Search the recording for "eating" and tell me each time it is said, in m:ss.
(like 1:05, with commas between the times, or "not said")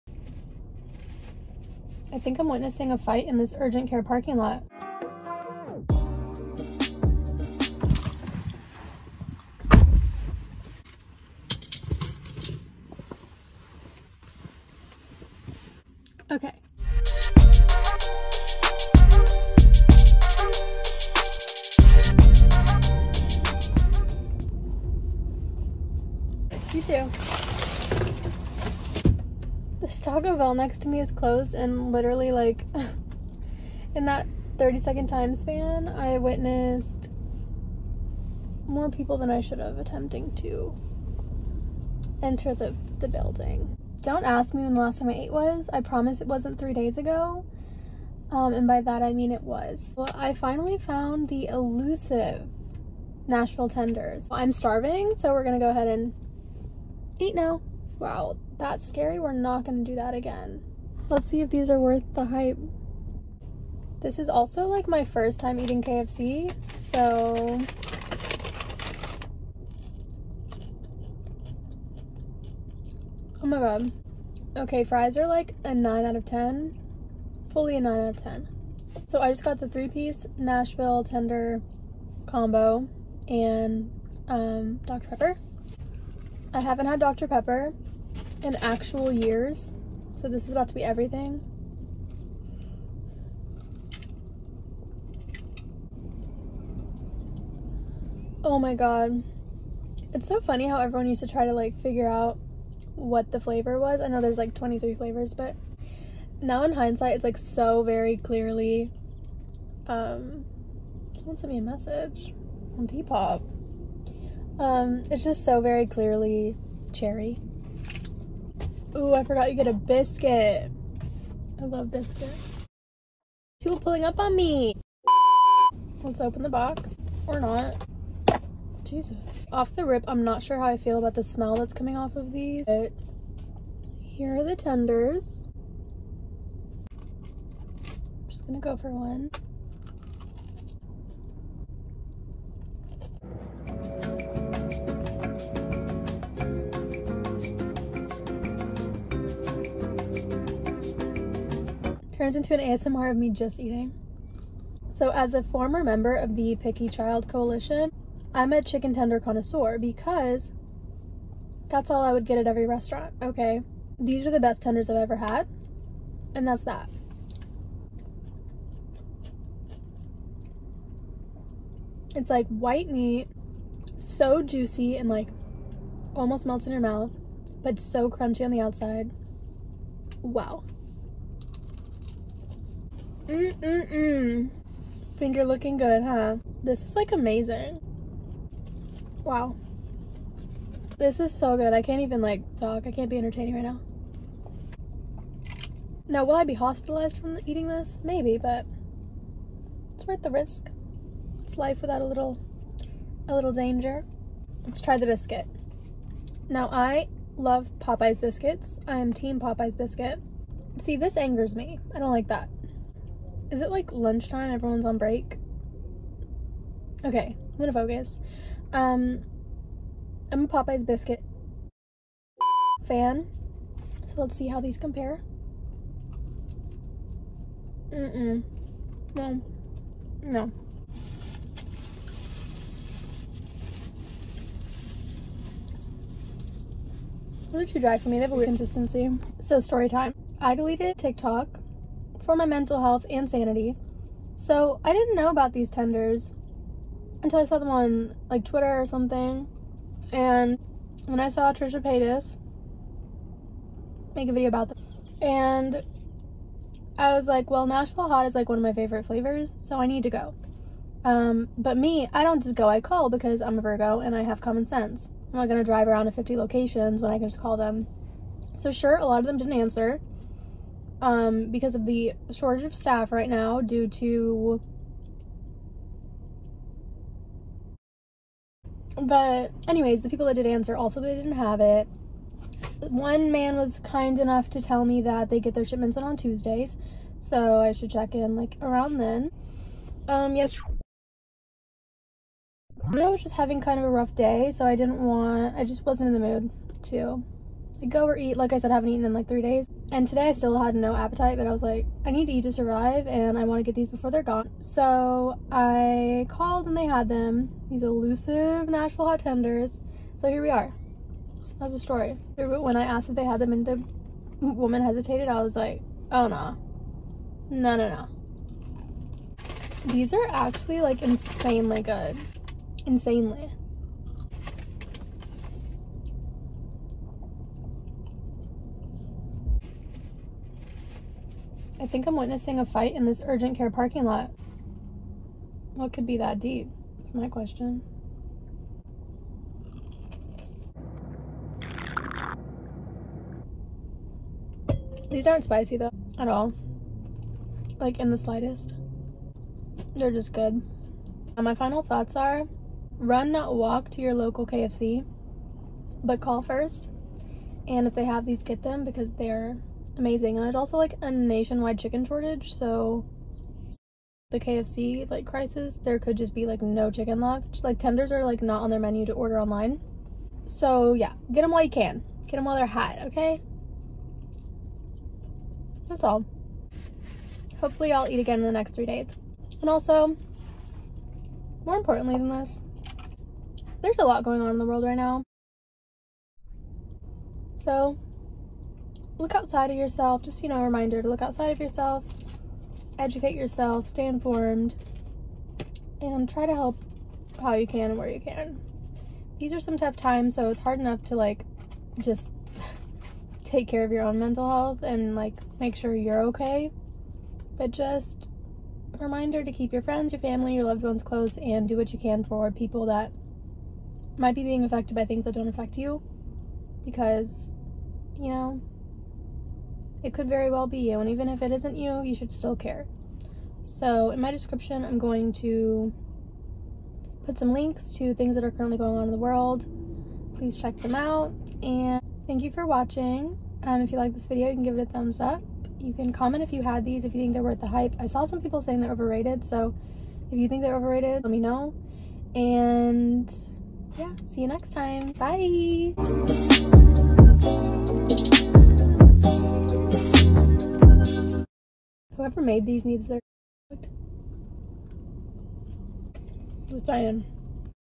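1:05, 2:33, 3:17.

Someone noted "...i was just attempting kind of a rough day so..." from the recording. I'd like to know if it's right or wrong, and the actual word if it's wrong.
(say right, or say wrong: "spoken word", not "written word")
wrong: "having", not "attempting".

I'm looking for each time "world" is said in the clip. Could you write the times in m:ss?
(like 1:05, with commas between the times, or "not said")
6:24, 7:09.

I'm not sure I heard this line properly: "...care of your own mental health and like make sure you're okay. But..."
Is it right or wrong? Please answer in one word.
right.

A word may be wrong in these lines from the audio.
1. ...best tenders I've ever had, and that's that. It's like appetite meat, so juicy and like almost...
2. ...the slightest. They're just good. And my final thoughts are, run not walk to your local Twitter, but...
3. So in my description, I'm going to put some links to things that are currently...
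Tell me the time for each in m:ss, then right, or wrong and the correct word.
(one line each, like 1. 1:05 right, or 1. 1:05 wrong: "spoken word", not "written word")
1. 2:44 wrong: "white", not "appetite"
2. 5:48 wrong: "KFC", not "Twitter"
3. 7:03 right.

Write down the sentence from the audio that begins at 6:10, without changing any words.
So yeah, get them while you can.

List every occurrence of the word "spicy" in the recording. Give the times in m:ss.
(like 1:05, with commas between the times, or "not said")
5:45.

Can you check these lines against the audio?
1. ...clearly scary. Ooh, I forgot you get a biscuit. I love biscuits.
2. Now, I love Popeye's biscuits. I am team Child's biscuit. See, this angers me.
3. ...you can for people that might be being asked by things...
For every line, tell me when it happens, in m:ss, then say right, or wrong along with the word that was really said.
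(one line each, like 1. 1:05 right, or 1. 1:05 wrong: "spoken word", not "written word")
1. 1:55 wrong: "cherry", not "scary"
2. 3:26 wrong: "Popeye", not "Child"
3. 6:51 wrong: "affected", not "asked".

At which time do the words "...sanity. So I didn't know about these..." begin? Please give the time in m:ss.
4:03.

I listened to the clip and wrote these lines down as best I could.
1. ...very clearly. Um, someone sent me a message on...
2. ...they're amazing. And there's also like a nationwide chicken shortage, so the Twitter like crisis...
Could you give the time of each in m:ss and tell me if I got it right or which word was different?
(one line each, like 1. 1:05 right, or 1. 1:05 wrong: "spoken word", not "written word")
1. 1:47 right
2. 5:59 wrong: "KFC", not "Twitter".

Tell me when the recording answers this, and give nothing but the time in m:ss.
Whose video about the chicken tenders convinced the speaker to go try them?
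4:11.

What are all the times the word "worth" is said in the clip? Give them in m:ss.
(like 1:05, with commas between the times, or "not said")
1:01, 3:20, 7:17.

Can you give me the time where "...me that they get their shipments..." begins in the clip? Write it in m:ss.
4:44.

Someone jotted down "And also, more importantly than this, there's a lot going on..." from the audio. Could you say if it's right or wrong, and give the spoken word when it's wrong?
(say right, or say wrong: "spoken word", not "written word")
right.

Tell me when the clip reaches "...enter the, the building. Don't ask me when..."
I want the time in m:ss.
0:42.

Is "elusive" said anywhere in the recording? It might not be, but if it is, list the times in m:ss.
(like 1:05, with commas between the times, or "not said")
0:51, 5:07.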